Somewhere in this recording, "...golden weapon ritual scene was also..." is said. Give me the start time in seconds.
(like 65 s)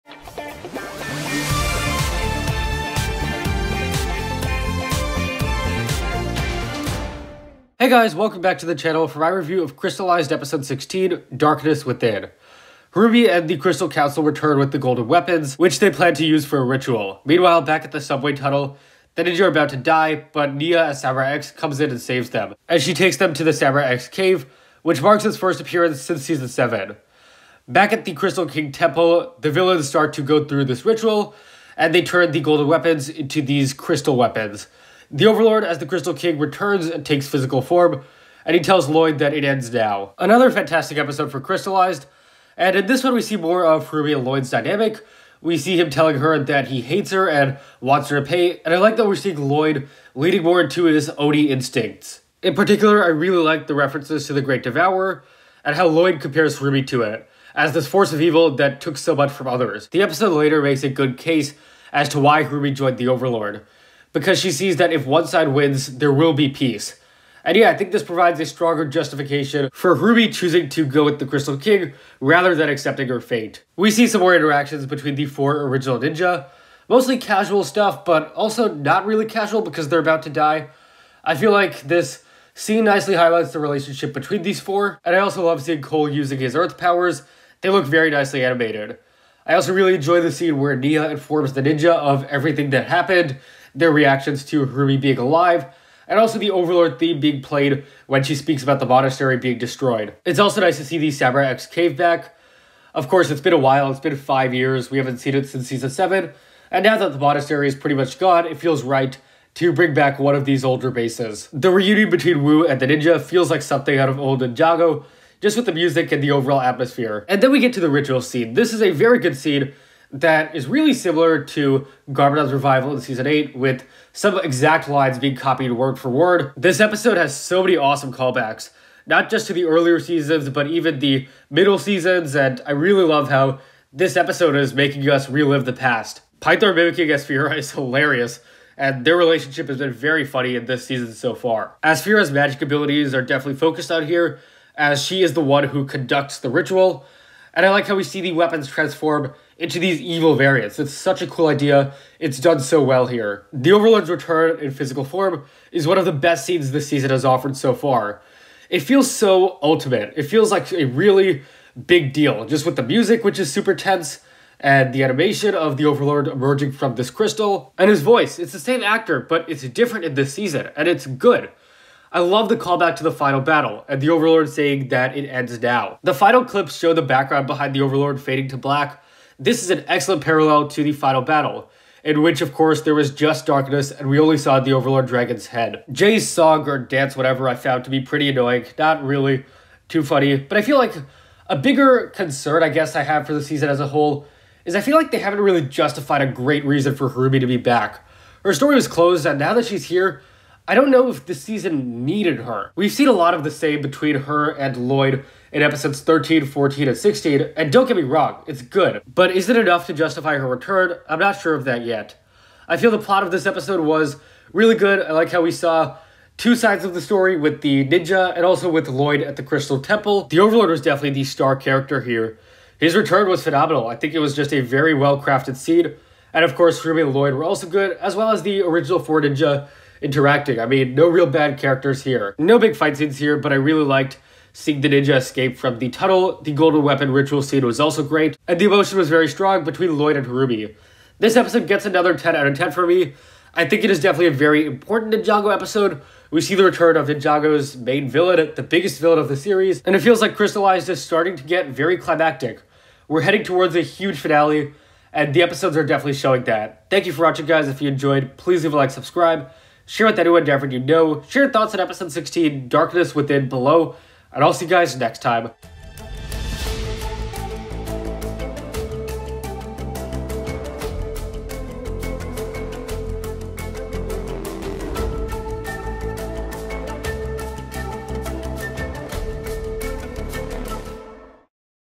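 236 s.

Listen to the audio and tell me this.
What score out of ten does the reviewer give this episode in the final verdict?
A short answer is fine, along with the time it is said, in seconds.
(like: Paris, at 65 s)
10, at 242 s.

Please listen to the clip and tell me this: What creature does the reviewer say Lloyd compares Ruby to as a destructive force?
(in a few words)
Great Devourer.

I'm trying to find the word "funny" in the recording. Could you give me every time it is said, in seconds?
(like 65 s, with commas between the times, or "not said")
140 s, 190 s.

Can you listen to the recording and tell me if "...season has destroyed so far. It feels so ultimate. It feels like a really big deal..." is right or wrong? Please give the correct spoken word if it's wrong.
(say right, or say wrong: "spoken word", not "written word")
wrong: "offered", not "destroyed".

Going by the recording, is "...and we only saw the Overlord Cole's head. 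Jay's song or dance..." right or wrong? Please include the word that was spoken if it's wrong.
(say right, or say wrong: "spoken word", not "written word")
wrong: "Dragon", not "Cole".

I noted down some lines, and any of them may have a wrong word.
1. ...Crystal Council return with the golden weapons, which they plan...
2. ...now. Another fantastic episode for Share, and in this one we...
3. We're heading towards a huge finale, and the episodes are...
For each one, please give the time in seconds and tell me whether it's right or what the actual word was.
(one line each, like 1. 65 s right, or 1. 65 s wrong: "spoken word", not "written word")
1. 13 s right
2. 39 s wrong: "Crystallized", not "Share"
3. 253 s right.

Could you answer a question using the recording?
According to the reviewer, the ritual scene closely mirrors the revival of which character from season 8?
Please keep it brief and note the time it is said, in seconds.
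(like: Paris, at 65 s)
Garmadon, at 122 s.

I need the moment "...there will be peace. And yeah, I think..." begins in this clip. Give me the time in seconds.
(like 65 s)
65 s.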